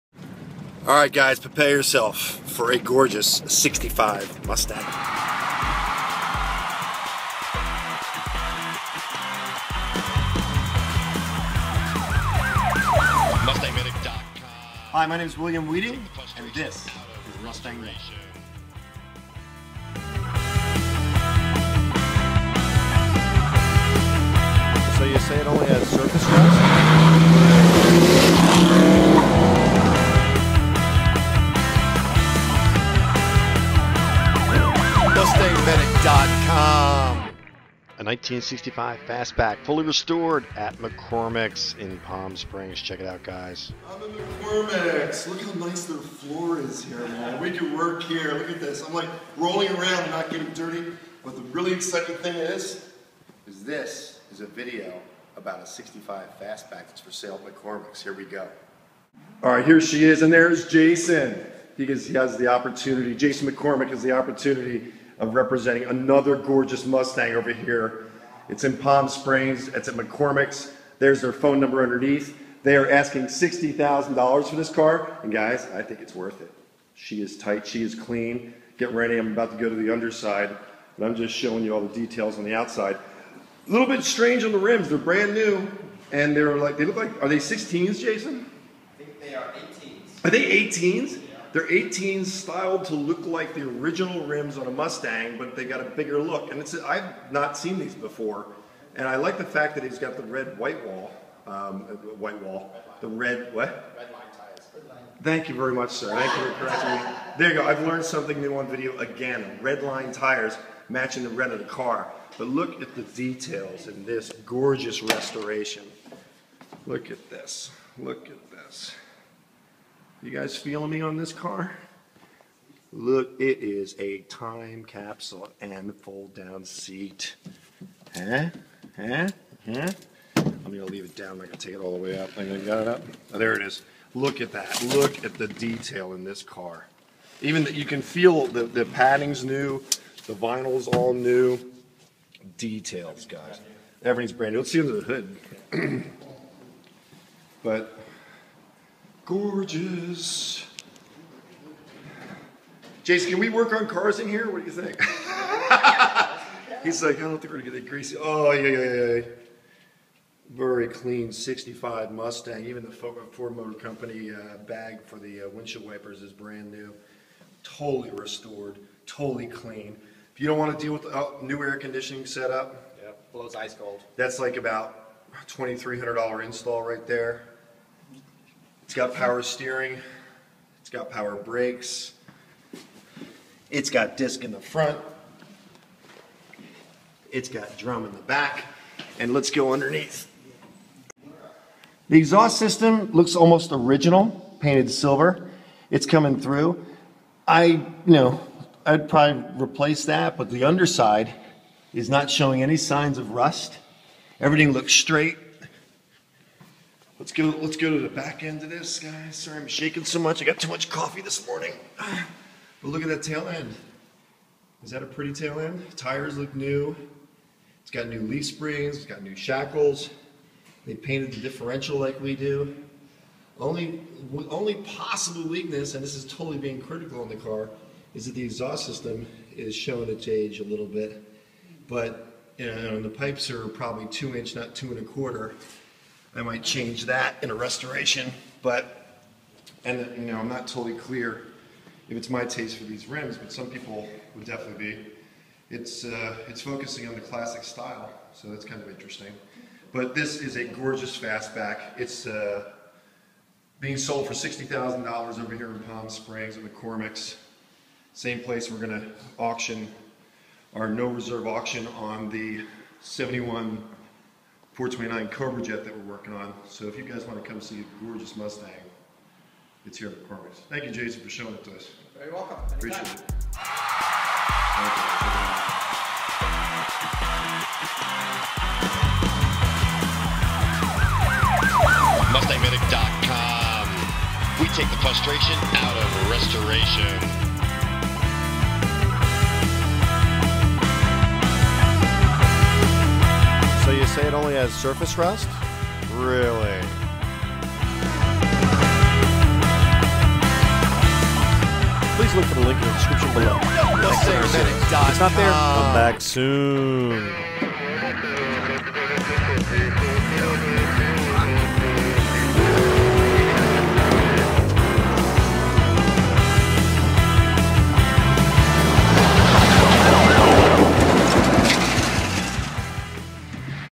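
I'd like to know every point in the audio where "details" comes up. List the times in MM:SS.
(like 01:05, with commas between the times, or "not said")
01:21, 01:53, 02:15, 02:22.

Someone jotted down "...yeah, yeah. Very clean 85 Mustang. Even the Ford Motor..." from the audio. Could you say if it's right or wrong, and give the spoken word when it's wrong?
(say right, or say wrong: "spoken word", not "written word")
wrong: "65", not "85".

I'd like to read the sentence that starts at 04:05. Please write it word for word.
It's, uh, it's focusing on the classic style, so that's kind of interesting.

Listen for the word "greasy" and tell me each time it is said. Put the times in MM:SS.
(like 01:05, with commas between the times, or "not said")
02:37.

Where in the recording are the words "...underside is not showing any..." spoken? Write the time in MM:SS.
03:20.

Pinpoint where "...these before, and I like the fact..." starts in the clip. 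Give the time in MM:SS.
01:37.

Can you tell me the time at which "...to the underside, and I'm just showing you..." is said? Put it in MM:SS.
01:19.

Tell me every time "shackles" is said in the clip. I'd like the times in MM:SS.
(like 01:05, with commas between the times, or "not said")
03:39.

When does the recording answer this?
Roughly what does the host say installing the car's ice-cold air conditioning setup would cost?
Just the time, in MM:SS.
02:55.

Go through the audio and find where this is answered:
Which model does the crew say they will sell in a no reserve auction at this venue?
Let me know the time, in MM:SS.
04:23.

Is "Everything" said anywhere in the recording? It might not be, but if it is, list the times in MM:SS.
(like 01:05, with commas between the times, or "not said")
02:24, 03:24.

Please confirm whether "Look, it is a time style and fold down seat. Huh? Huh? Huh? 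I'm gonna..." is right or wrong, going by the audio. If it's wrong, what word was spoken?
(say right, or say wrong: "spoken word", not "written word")
wrong: "capsule", not "style".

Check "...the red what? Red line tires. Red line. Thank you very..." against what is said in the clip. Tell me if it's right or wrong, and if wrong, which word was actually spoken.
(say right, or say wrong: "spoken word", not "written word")
right.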